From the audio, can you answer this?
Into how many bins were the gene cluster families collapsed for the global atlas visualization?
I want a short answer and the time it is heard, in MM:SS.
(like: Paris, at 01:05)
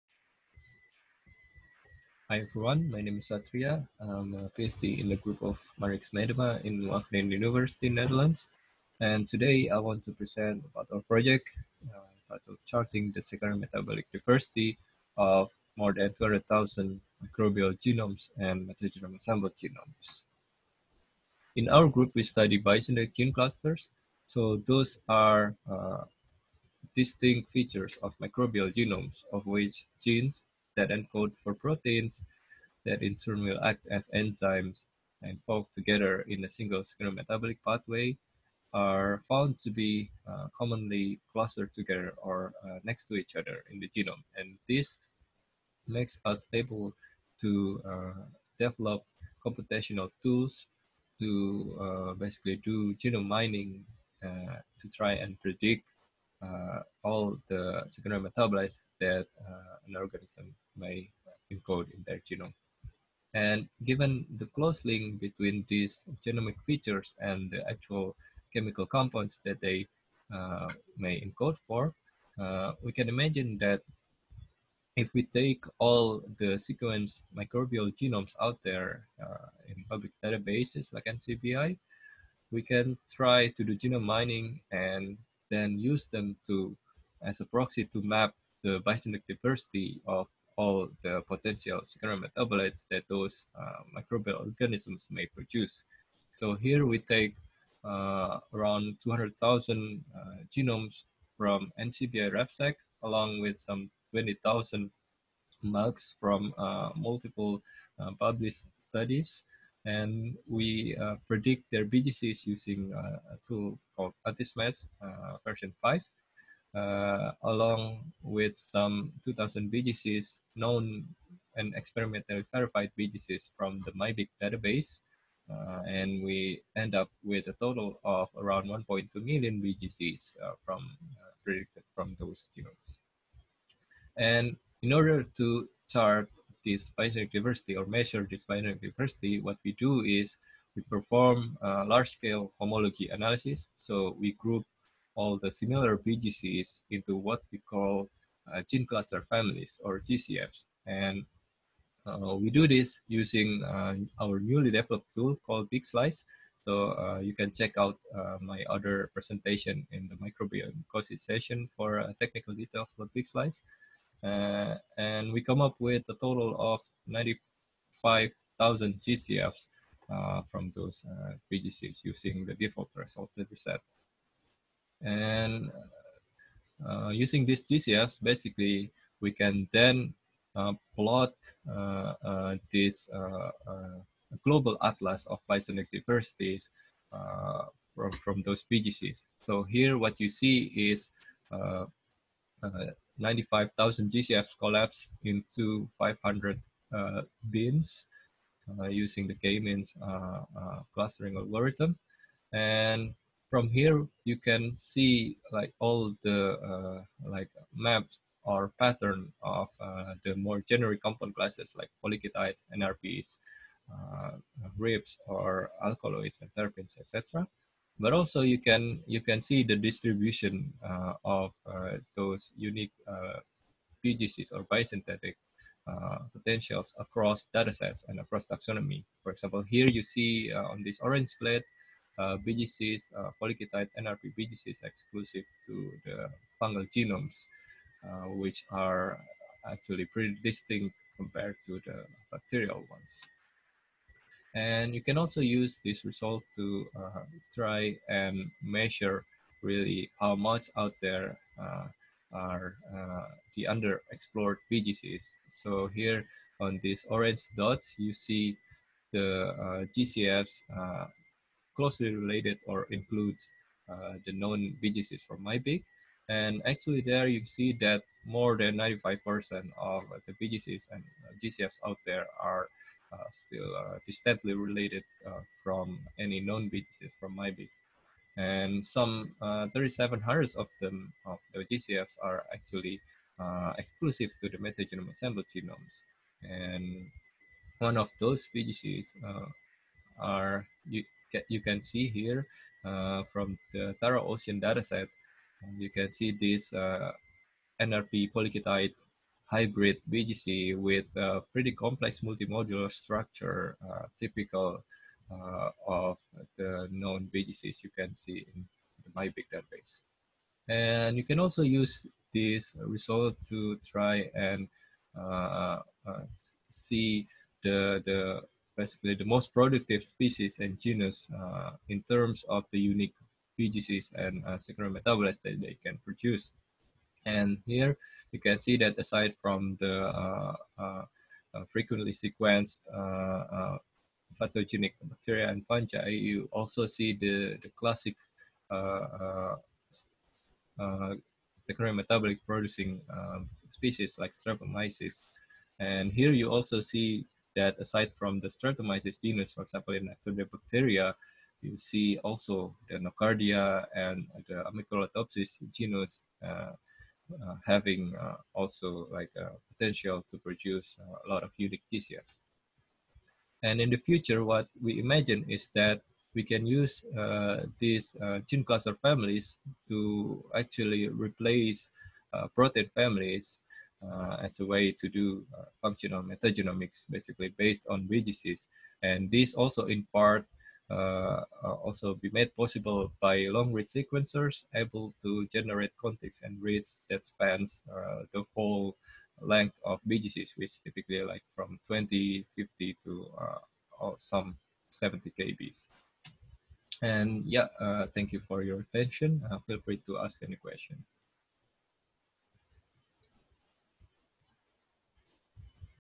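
500, at 03:15.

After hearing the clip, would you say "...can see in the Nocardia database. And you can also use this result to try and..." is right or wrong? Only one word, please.
wrong.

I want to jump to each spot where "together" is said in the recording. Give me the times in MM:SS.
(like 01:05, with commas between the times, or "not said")
00:35, 00:41.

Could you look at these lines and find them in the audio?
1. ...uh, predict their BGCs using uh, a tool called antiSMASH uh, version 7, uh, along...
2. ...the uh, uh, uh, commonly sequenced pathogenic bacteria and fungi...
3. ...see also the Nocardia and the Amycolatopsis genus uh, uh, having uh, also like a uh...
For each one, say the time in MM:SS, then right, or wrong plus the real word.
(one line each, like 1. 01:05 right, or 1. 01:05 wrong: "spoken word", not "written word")
1. 01:51 wrong: "5", not "7"
2. 05:29 wrong: "frequently", not "commonly"
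3. 05:51 right.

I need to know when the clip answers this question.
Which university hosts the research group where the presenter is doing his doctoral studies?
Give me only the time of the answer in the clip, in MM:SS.
00:06.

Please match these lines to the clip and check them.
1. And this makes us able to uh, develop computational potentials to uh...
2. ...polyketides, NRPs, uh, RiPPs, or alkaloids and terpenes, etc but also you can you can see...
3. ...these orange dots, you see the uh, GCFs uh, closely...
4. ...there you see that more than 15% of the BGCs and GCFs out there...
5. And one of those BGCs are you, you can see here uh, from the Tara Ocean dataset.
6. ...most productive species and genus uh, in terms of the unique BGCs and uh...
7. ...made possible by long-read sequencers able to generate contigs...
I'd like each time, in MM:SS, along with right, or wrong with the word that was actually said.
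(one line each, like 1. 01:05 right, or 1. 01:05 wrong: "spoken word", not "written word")
1. 00:44 wrong: "tools", not "potentials"
2. 03:32 right
3. 04:16 right
4. 04:27 wrong: "95", not "15"
5. 04:46 right
6. 05:19 right
7. 06:22 right.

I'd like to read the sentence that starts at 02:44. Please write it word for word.
Uh, and we come up with a total of 95,000 GCFs uh, from those uh, BGCs using the default that we set.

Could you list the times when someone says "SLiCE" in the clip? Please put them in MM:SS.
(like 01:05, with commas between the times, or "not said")
02:35, 02:43.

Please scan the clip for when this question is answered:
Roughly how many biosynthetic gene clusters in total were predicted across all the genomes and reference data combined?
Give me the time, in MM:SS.
02:08.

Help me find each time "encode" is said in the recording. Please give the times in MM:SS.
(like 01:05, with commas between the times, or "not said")
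00:30, 01:01, 01:11.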